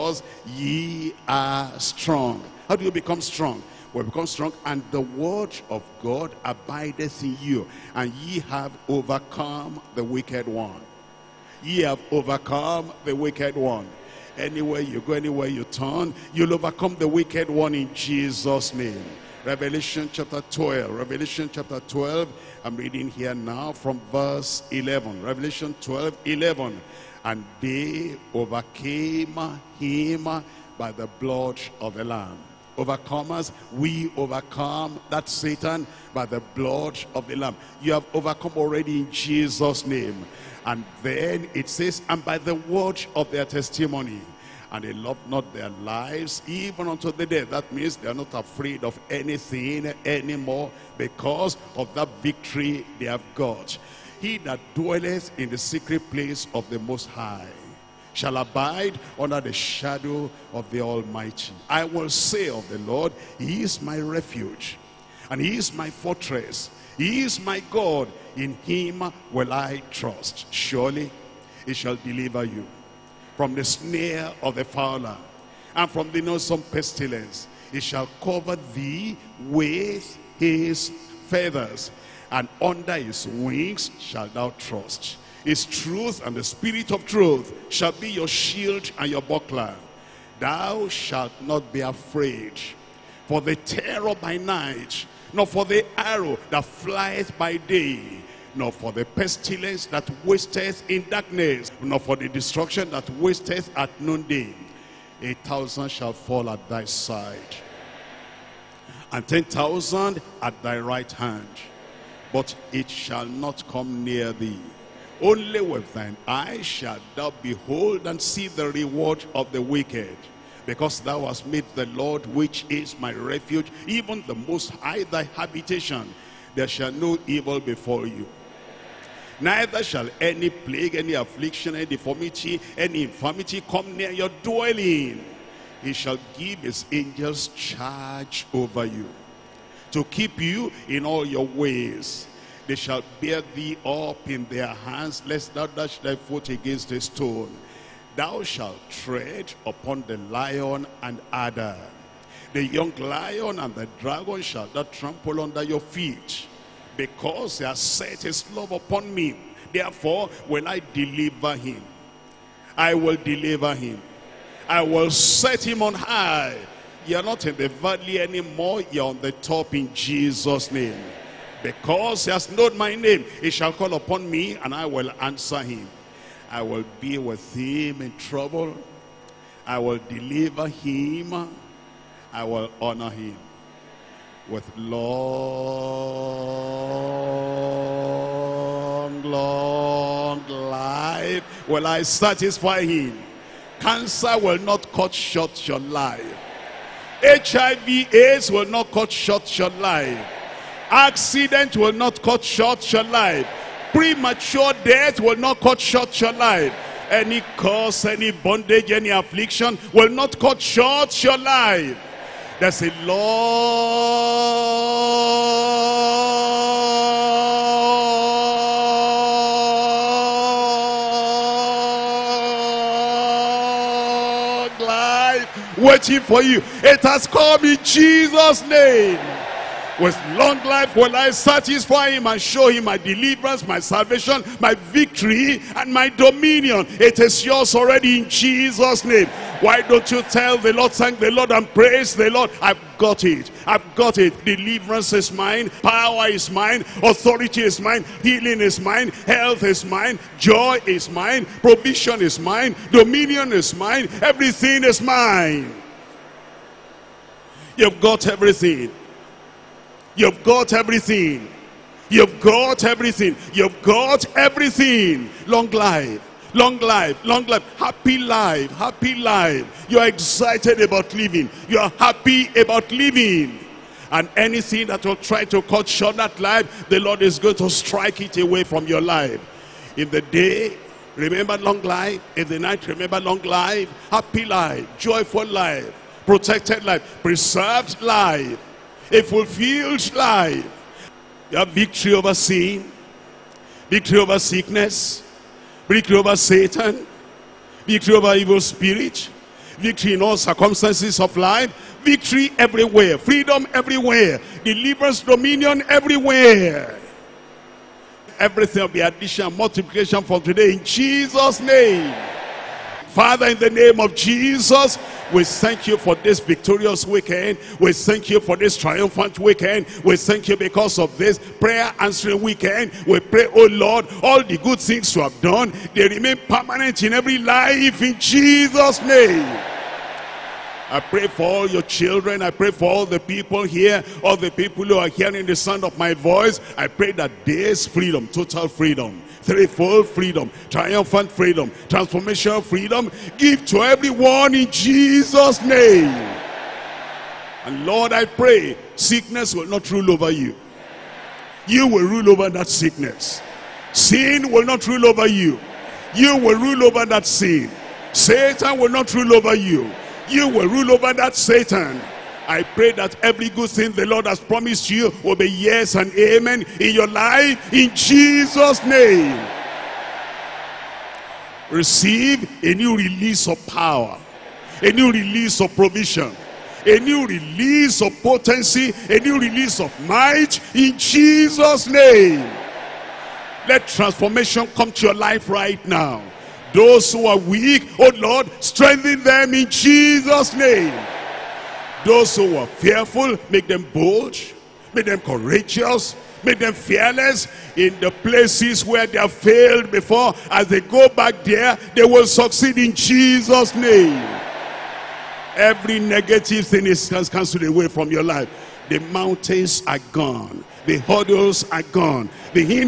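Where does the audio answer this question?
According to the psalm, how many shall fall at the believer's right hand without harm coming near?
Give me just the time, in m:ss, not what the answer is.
1:49.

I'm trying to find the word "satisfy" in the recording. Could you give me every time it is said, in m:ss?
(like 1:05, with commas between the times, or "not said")
3:12, 3:51.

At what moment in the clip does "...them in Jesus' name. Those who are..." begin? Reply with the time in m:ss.
6:29.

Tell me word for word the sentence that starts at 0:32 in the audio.
Overcomers, we overcome that Satan by the blood of the Lamb.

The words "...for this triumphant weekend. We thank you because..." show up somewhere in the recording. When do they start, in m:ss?
5:18.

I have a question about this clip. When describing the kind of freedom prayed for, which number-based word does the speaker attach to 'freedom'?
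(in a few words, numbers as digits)
Threefold.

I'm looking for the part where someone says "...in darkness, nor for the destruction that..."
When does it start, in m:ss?
1:40.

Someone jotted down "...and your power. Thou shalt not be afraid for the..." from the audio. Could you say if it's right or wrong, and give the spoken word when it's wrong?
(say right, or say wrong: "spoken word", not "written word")
wrong: "buckler", not "power".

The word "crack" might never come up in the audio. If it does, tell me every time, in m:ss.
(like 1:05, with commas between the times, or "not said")
not said.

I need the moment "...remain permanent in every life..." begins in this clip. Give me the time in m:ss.
5:26.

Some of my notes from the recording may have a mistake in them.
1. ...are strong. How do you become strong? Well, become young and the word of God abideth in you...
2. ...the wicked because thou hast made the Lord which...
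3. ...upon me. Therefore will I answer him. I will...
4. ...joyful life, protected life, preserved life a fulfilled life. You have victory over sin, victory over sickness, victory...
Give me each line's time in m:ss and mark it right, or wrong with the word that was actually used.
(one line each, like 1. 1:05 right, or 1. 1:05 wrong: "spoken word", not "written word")
1. 0:01 wrong: "strong", not "young"
2. 1:59 right
3. 2:38 wrong: "deliver", not "answer"
4. 4:44 right.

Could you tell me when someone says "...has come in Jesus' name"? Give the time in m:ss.
3:47.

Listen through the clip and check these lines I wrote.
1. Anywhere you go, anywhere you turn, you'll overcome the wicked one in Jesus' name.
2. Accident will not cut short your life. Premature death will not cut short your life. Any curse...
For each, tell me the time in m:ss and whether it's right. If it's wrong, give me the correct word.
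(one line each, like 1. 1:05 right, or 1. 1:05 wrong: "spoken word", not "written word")
1. 0:14 right
2. 3:20 right.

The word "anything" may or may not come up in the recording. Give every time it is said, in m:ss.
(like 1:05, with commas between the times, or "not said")
0:49, 4:34.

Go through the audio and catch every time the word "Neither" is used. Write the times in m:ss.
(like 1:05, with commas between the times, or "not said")
2:09.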